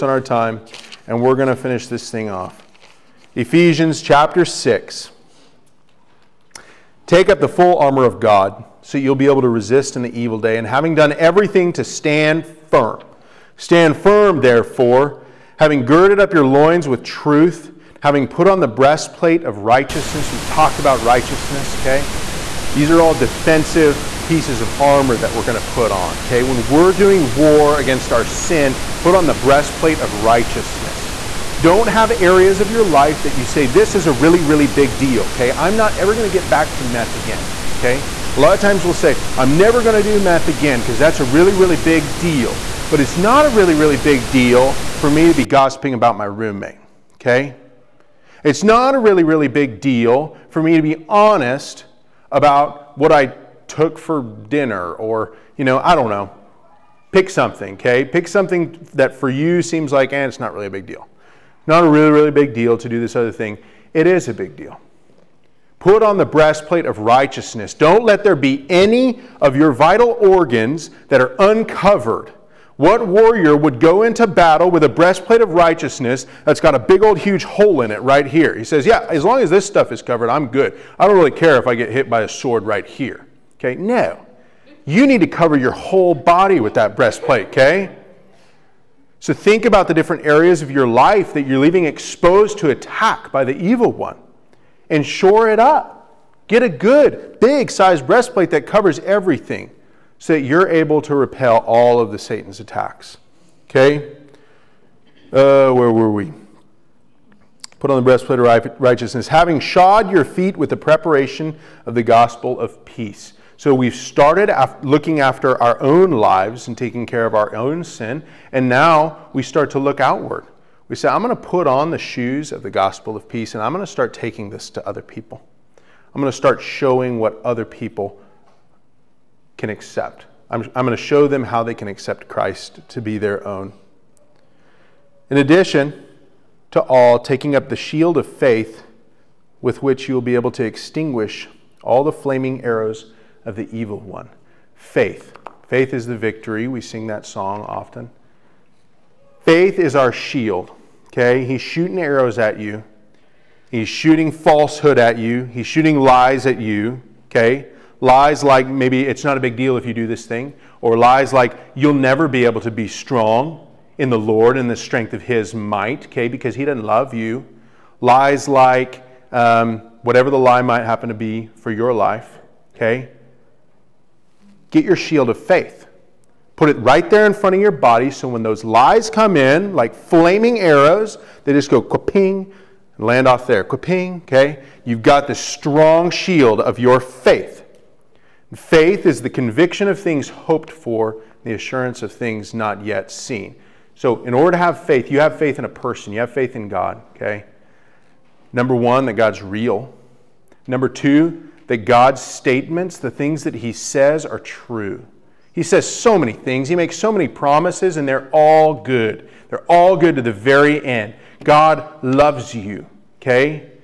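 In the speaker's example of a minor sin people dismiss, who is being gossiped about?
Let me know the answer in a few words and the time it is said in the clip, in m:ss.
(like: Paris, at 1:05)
roommate, at 0:46.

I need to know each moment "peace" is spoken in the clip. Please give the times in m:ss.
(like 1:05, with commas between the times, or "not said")
1:52, 2:03.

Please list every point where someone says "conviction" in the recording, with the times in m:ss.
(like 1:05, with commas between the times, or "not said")
3:09.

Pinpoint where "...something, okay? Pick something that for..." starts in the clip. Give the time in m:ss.
0:57.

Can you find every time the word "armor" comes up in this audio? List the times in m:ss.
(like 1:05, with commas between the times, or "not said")
0:07, 0:24.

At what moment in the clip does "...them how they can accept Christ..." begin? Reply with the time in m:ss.
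2:11.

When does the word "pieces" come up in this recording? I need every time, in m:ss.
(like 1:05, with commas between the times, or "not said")
0:24.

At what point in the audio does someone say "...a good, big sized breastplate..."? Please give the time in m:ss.
1:36.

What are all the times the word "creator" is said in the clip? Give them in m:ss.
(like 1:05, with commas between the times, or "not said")
not said.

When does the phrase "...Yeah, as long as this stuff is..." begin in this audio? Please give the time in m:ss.
1:18.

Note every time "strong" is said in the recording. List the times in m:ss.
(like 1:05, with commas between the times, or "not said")
2:42, 3:05.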